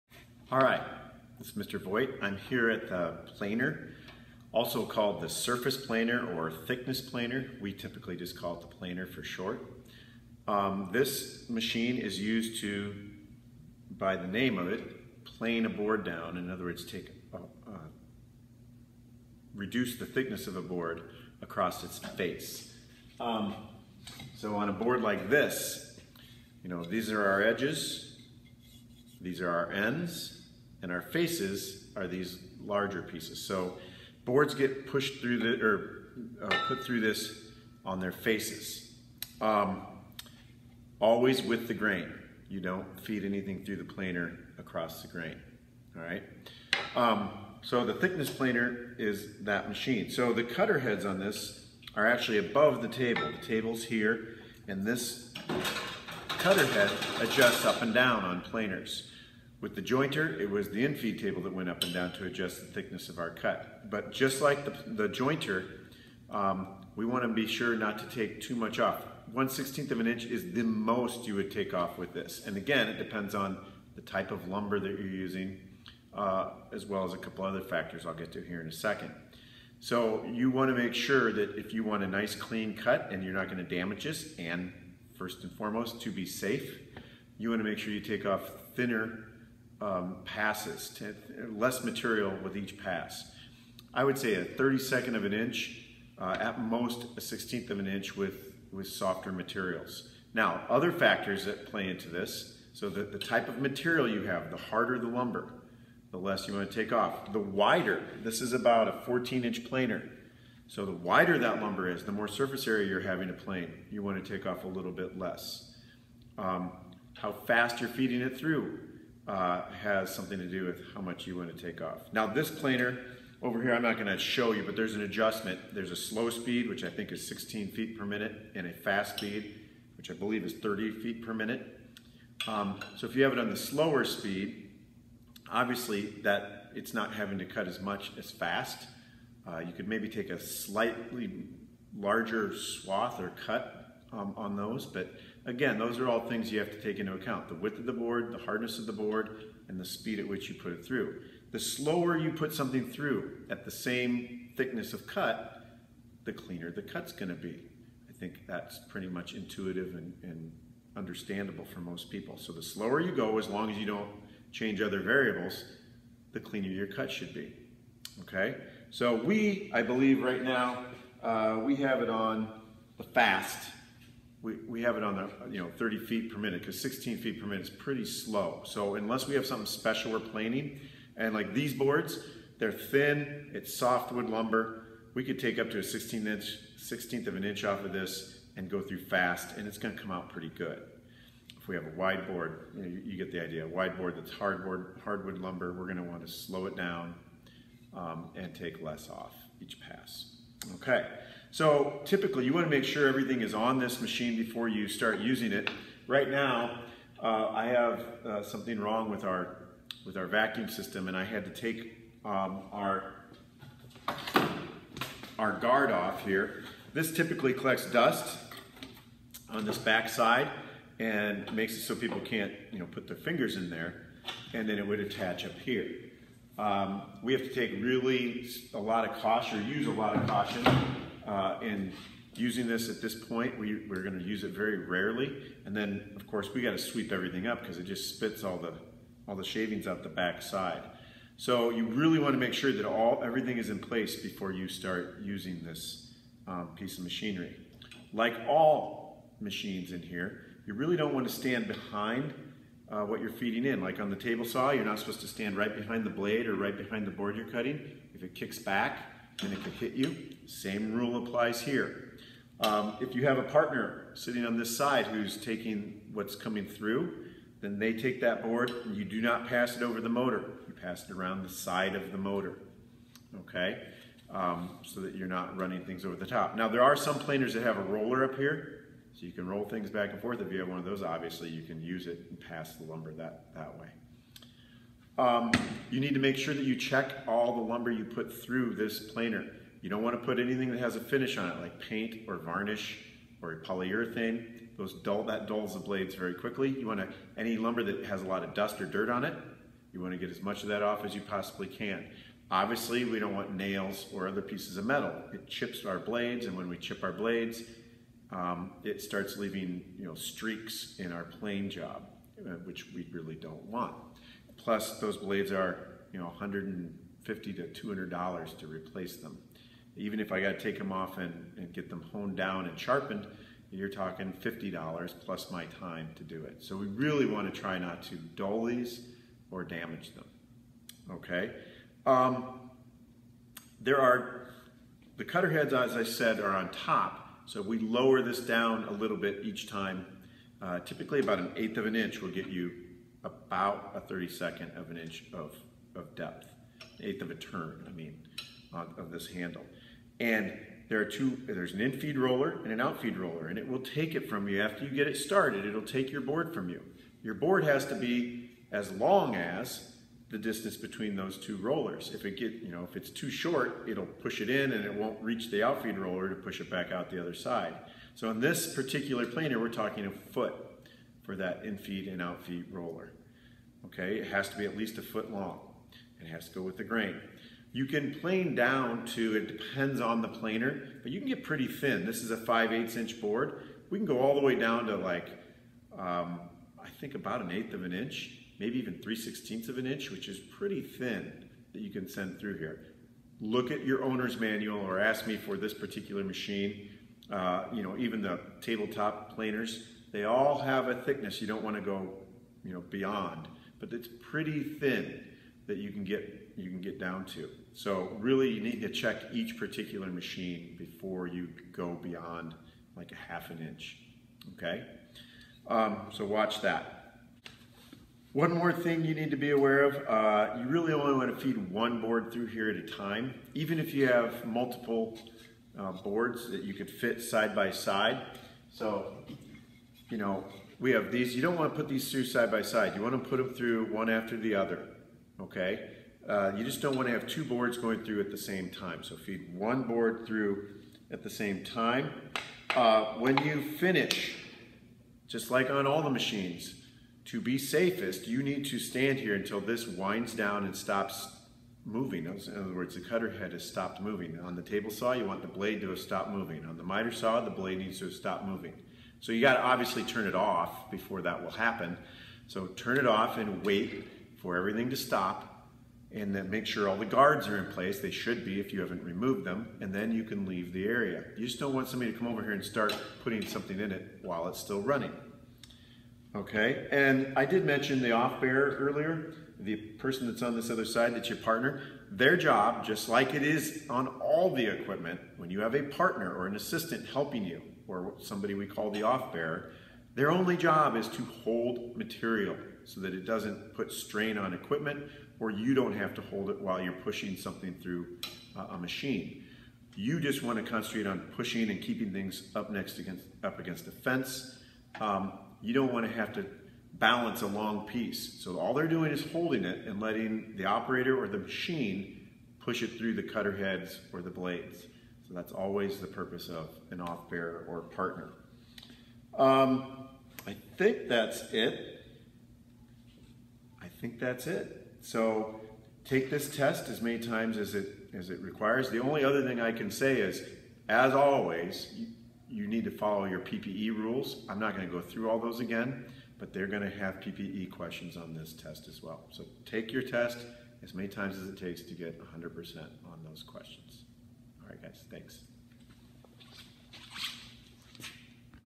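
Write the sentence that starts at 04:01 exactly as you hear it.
So you really wanna make sure that all everything is in place before you start using this um, piece of machinery.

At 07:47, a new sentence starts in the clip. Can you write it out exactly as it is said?
They should be if you haven't removed them and then you can leave the area.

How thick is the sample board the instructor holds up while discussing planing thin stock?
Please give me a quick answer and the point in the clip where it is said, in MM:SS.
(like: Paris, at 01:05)
5/8 inch, at 06:22.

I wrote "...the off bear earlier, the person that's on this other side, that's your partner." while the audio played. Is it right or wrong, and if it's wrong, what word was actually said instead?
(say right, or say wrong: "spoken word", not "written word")
right.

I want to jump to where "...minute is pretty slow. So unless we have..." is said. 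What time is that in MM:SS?
02:57.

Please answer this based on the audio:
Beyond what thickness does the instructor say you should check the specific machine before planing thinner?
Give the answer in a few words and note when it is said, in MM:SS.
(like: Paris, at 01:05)
half an inch, at 06:53.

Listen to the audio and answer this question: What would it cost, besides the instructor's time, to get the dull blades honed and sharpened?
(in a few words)
$50.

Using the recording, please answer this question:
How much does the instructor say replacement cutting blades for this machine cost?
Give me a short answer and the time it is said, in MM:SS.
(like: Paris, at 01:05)
$150 to $200, at 05:16.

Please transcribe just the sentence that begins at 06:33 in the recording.
Look at your owner's manual or ask me for this particular machine.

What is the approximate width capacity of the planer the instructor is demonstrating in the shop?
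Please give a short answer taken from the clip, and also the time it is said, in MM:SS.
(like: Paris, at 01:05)
14 inch, at 01:49.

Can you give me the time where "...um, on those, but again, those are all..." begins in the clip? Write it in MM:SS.
02:24.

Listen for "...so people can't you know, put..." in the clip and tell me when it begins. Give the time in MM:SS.
03:41.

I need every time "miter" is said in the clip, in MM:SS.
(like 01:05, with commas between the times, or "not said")
07:36.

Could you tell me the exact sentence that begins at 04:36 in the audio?
Now there are some planers that have a roller up here, so you can roll things back and forth.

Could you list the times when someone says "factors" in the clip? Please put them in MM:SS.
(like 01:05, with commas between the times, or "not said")
01:17, 01:40.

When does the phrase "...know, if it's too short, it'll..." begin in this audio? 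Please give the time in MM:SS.
06:02.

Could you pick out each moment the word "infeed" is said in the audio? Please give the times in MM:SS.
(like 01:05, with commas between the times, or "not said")
01:00, 05:51.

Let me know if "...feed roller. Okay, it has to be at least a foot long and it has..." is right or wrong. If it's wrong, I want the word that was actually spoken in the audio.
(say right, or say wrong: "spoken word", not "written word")
right.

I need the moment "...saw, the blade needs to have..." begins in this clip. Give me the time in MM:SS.
07:37.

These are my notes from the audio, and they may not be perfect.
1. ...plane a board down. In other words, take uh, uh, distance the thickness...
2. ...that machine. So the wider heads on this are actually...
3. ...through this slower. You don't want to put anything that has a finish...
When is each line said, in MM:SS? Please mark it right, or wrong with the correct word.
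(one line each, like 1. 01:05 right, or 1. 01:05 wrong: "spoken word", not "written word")
1. 00:15 wrong: "reduce", not "distance"
2. 00:49 wrong: "cutter", not "wider"
3. 04:48 wrong: "planer", not "slower".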